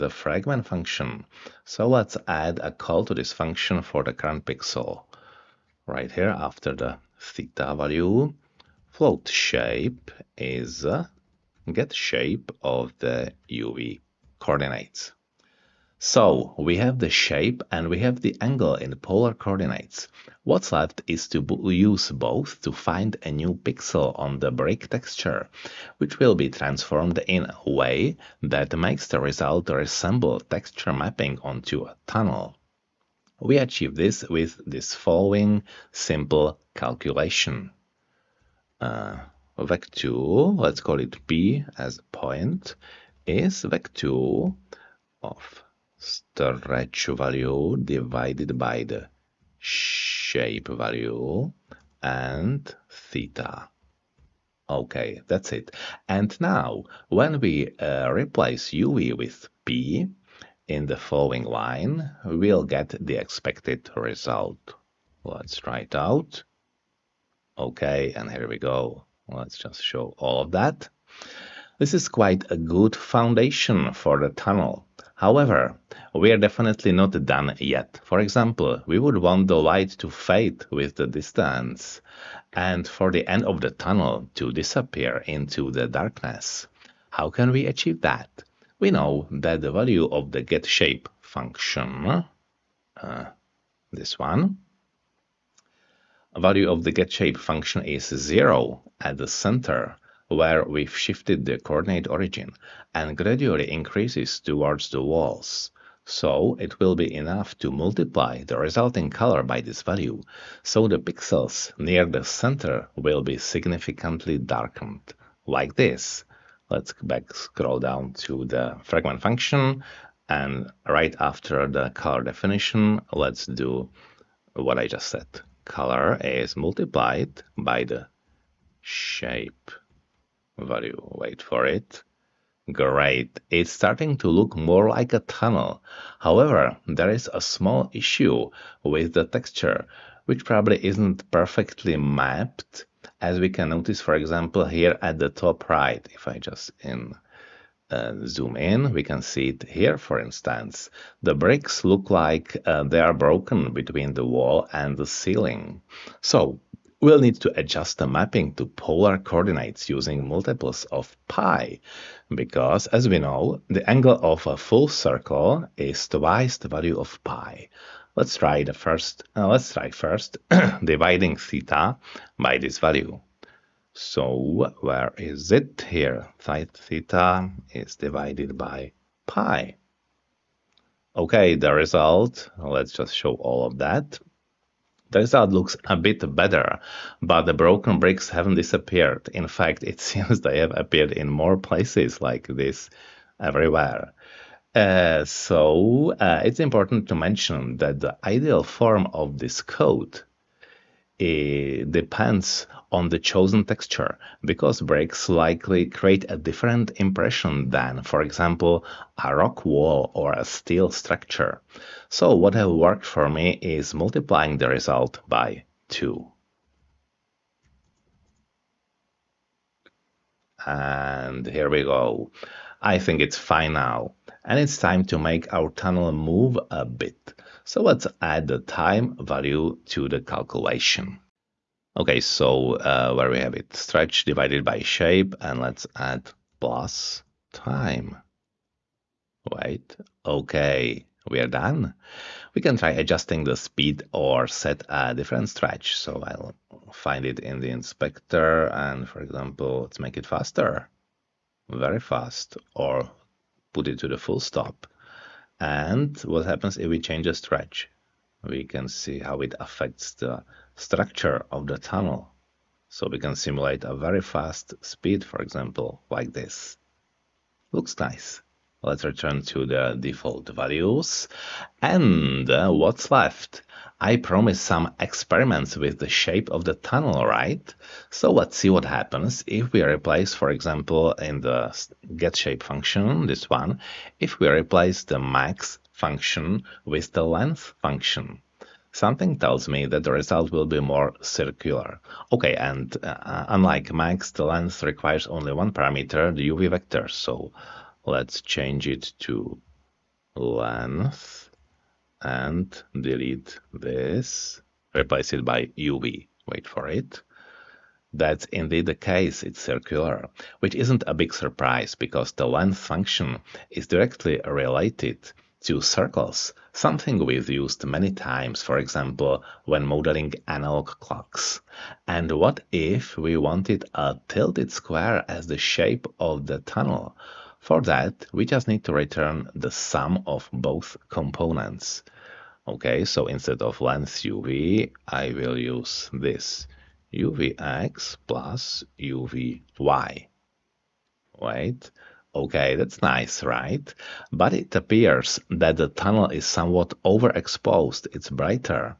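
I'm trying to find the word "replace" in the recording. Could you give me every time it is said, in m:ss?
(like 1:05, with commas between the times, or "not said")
0:58, 4:39, 4:44, 5:04.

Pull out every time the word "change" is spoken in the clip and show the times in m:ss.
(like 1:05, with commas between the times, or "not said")
4:17, 4:58.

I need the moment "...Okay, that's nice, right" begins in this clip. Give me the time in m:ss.
5:42.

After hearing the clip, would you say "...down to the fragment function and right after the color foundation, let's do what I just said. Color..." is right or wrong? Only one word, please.
wrong.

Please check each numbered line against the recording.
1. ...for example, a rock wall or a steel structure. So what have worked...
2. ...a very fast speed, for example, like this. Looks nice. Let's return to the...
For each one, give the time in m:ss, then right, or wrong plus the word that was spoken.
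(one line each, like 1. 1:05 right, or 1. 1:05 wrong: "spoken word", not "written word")
1. 3:28 right
2. 4:23 right.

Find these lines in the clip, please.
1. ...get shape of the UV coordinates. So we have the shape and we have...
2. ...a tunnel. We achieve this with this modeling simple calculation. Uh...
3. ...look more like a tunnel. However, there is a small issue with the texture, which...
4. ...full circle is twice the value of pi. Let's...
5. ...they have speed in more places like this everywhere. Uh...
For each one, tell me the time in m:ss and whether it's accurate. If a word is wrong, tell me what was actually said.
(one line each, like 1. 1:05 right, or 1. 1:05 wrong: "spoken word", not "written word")
1. 0:11 right
2. 0:31 wrong: "following", not "modeling"
3. 2:14 right
4. 2:44 right
5. 3:10 wrong: "appeared", not "speed".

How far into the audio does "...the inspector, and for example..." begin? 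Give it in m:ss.
4:07.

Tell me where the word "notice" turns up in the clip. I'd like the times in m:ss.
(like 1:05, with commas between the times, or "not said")
2:23.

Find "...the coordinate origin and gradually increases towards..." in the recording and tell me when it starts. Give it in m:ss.
1:41.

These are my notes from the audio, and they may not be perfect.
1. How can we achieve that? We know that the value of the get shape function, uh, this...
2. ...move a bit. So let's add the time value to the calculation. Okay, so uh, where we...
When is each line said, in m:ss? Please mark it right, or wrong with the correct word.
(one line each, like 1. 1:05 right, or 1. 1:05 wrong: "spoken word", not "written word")
1. 1:27 right
2. 3:46 right.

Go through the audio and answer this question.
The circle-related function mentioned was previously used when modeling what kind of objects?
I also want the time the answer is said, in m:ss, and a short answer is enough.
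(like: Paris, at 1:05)
analog clocks, at 5:20.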